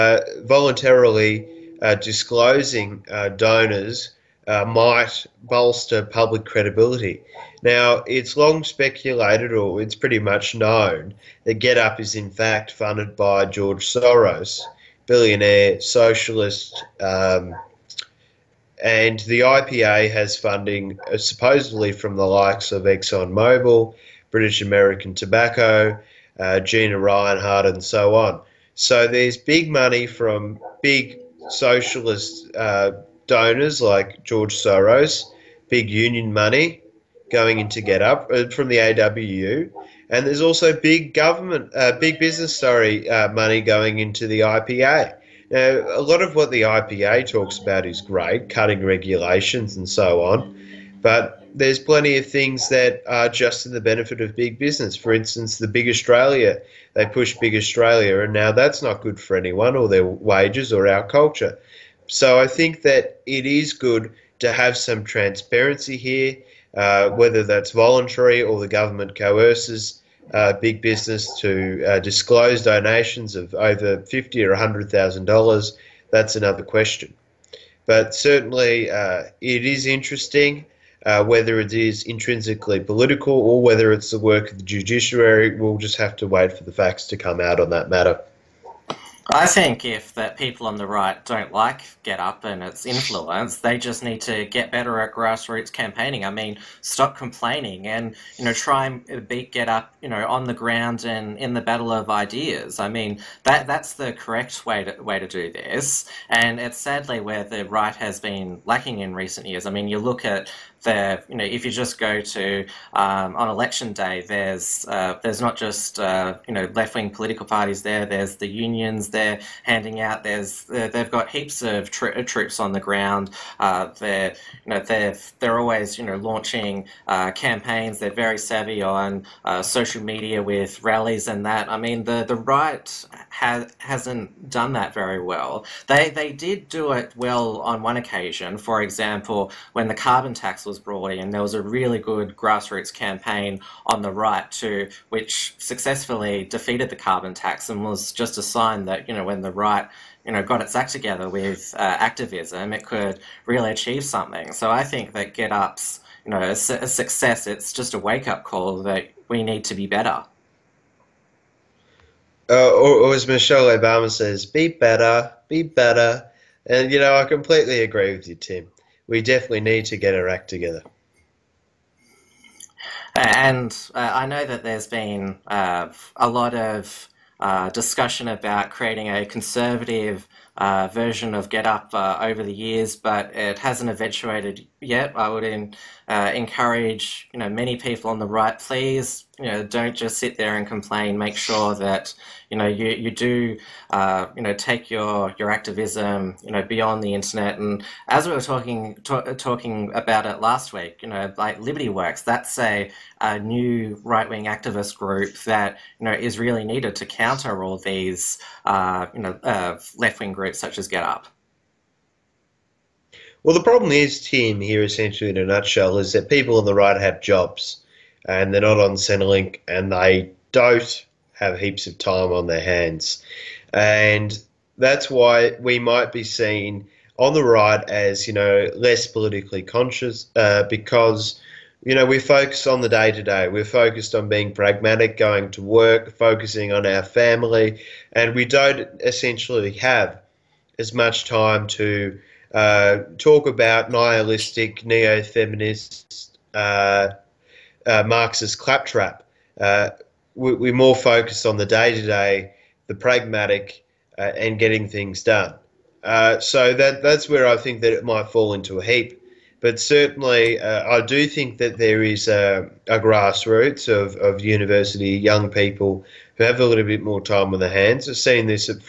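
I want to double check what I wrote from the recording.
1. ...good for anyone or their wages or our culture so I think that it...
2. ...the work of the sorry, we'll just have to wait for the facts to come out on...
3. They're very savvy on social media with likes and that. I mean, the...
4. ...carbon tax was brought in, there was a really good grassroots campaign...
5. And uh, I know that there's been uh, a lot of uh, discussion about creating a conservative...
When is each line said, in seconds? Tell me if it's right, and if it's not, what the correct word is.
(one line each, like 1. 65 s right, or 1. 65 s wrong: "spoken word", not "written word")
1. 59 s right
2. 84 s wrong: "judiciary", not "sorry"
3. 127 s wrong: "rallies", not "likes"
4. 139 s right
5. 173 s right.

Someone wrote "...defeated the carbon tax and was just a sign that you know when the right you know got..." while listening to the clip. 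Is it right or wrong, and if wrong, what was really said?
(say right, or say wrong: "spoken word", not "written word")
right.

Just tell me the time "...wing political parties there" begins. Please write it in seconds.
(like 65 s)
116 s.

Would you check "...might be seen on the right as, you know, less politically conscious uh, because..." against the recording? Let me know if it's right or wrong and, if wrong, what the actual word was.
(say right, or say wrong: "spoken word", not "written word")
right.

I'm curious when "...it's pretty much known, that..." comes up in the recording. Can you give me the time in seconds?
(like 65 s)
9 s.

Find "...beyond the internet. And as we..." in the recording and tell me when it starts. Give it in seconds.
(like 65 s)
196 s.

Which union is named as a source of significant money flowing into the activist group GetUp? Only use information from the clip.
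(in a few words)
AWU.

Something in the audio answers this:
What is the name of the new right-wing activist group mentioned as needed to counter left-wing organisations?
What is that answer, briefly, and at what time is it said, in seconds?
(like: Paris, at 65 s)
Liberty Works, at 201 s.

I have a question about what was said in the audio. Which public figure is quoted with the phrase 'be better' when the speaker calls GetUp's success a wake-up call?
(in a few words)
Michelle Obama.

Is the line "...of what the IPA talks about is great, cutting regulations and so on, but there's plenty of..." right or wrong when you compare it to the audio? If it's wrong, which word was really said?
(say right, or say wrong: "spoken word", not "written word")
right.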